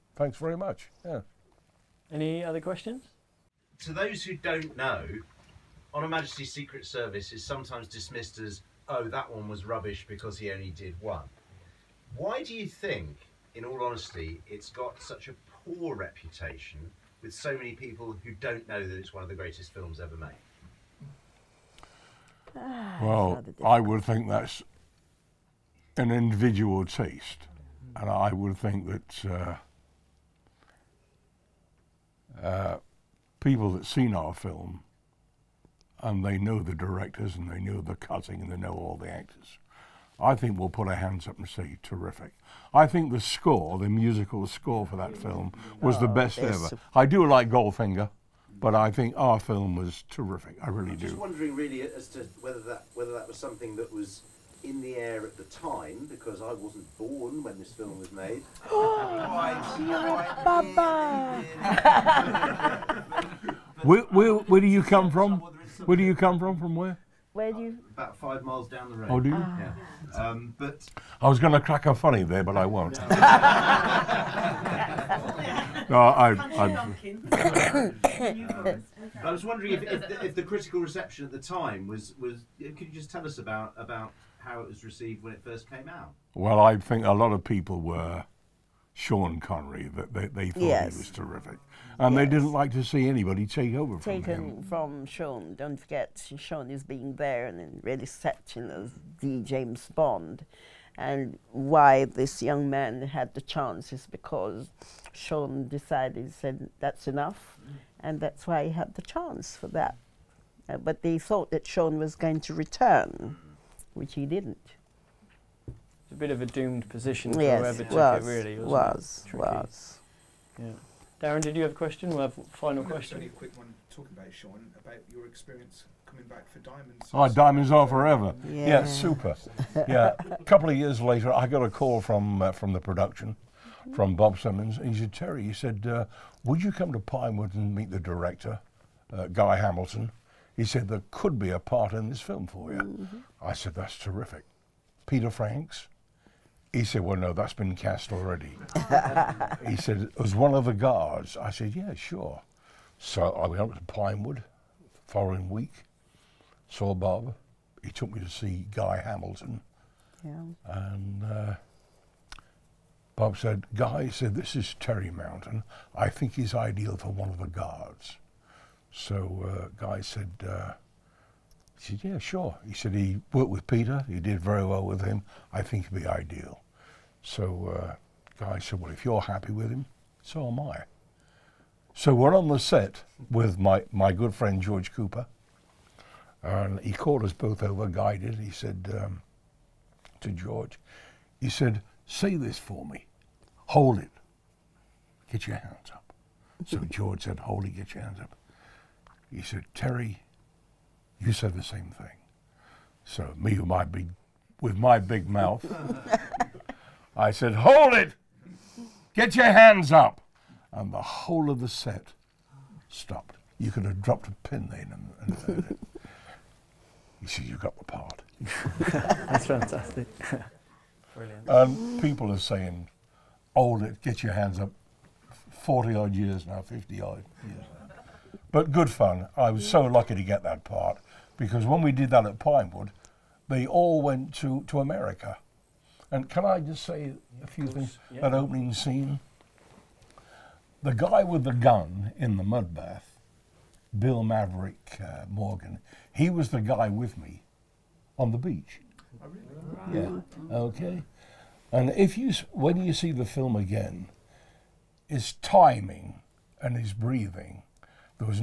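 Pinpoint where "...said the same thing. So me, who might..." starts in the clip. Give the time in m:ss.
3:21.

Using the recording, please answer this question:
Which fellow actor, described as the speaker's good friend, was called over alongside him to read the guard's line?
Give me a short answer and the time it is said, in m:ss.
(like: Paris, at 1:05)
George Cooper, at 3:04.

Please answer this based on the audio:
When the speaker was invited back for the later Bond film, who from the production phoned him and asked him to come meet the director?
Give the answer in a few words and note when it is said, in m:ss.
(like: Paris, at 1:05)
Bob Simmons, at 2:14.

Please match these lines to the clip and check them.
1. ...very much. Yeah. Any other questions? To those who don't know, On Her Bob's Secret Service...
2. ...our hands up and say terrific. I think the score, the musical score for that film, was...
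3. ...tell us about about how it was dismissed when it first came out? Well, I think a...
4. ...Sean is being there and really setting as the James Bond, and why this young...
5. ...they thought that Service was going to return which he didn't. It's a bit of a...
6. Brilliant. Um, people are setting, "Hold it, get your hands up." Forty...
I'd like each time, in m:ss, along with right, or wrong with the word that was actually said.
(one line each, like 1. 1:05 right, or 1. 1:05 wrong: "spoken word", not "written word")
1. 0:00 wrong: "Majesty", not "Bob"
2. 0:40 right
3. 1:23 wrong: "received", not "dismissed"
4. 1:36 right
5. 1:51 wrong: "Sean", not "Service"
6. 3:41 wrong: "saying", not "setting".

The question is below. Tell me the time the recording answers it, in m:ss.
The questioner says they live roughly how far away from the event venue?
1:08.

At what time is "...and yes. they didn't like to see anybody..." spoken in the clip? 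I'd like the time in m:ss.
1:31.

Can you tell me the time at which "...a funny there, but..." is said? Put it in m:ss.
1:11.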